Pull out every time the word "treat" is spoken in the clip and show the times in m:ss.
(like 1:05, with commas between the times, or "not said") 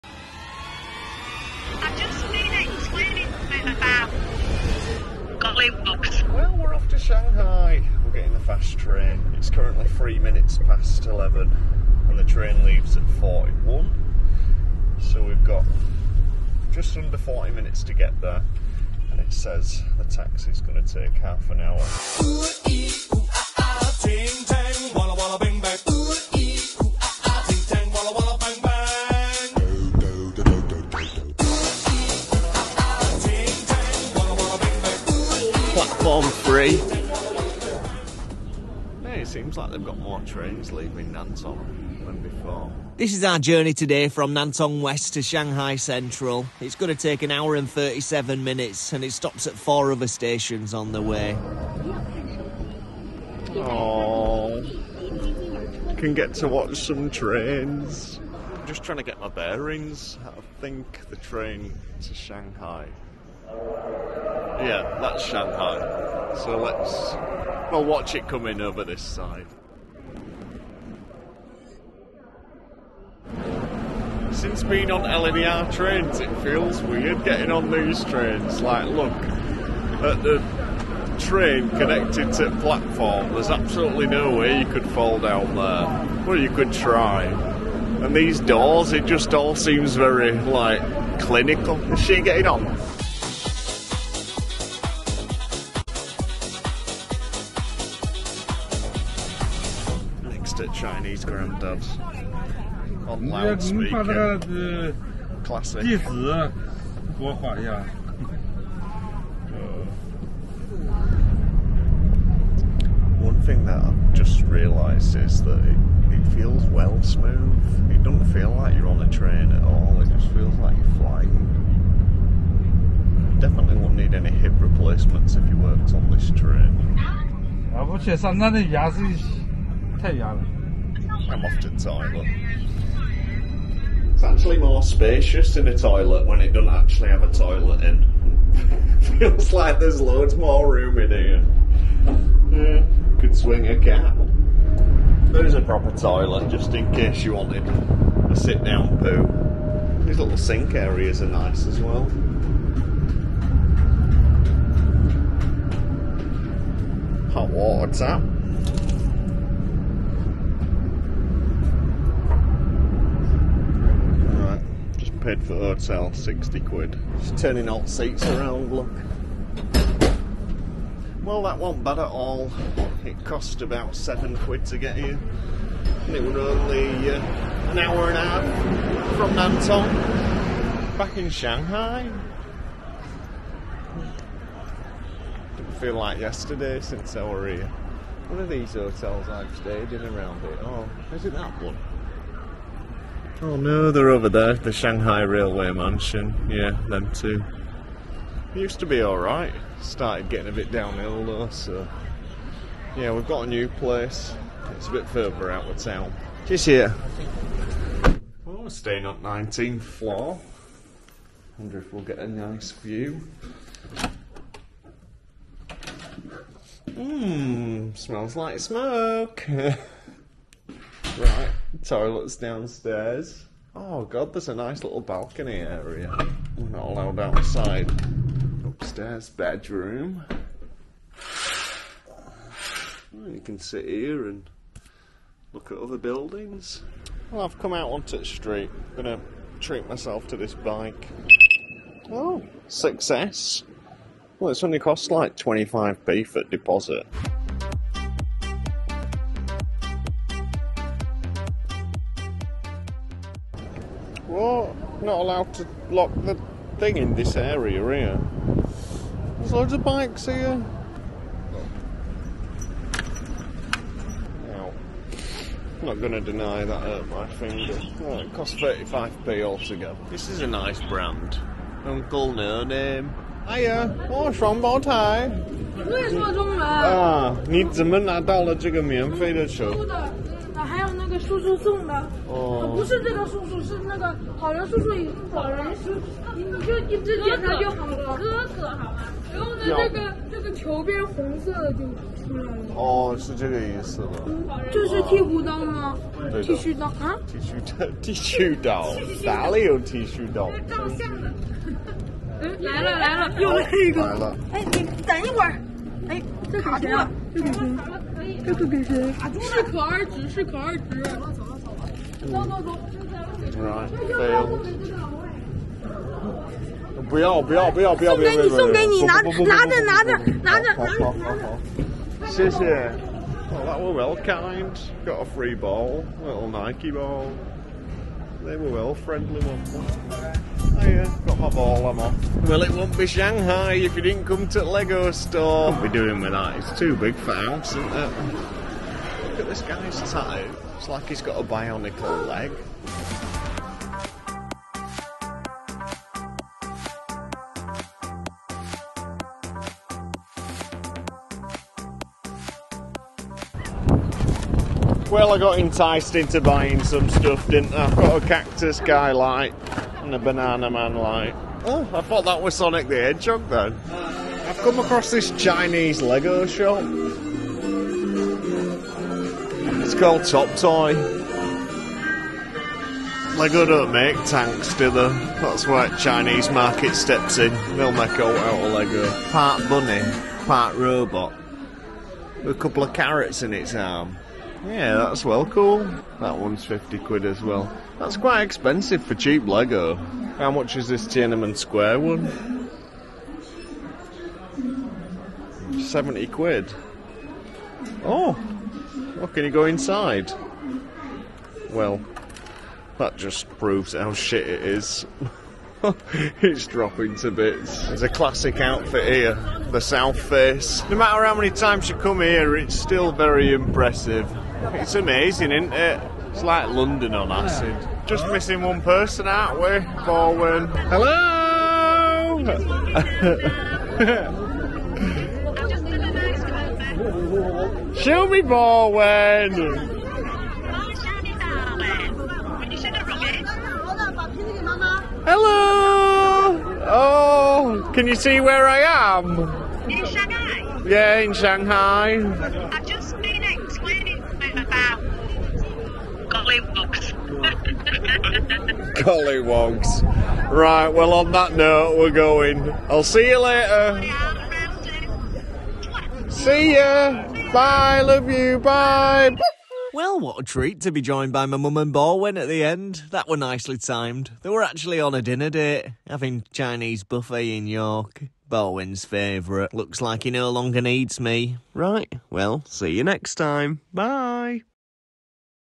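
3:59, 7:40.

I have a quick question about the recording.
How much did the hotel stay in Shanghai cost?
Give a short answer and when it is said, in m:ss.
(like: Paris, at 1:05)
60 quid, at 2:46.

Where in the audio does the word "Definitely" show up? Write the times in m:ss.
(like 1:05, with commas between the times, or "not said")
2:03.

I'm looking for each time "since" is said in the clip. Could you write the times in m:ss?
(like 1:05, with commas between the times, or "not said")
1:14, 3:06.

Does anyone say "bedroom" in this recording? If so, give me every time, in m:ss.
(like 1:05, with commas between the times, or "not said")
3:49.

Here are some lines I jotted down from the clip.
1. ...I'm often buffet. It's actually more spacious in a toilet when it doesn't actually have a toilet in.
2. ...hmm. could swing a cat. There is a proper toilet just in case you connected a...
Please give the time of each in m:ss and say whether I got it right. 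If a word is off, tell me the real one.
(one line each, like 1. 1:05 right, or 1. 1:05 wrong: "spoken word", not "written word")
1. 2:11 wrong: "toilet", not "buffet"
2. 2:22 wrong: "wanted", not "connected".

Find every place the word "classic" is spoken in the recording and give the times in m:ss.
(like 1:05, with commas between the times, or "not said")
1:45, 6:48.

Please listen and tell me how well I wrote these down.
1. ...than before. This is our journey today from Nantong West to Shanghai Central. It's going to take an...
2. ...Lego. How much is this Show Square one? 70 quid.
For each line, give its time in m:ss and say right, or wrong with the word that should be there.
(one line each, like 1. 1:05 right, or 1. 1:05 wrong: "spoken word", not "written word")
1. 0:42 right
2. 6:29 wrong: "Tiananmen", not "Show".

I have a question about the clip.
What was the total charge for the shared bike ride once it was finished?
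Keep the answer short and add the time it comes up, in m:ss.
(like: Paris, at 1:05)
35p, at 4:28.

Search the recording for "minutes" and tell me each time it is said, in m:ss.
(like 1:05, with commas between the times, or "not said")
0:10, 0:17, 0:48.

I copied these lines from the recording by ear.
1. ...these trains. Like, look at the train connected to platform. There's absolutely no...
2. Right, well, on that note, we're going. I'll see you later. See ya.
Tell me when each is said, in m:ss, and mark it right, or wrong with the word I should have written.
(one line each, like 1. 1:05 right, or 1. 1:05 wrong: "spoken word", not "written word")
1. 1:17 right
2. 7:30 right.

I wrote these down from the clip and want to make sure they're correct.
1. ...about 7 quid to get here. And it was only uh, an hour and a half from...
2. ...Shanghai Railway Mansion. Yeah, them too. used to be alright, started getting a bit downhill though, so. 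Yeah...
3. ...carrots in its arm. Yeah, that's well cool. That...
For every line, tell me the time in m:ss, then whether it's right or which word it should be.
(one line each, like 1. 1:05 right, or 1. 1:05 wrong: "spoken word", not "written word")
1. 2:53 right
2. 3:14 right
3. 6:22 right.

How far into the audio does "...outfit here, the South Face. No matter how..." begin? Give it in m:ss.
6:48.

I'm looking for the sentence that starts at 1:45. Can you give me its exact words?
Uh, one thing that I've just realised is that it, it feels well smooth.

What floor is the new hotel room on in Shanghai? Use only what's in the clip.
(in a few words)
19th floor.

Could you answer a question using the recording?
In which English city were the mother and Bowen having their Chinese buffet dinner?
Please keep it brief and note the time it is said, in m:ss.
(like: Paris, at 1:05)
York, at 7:47.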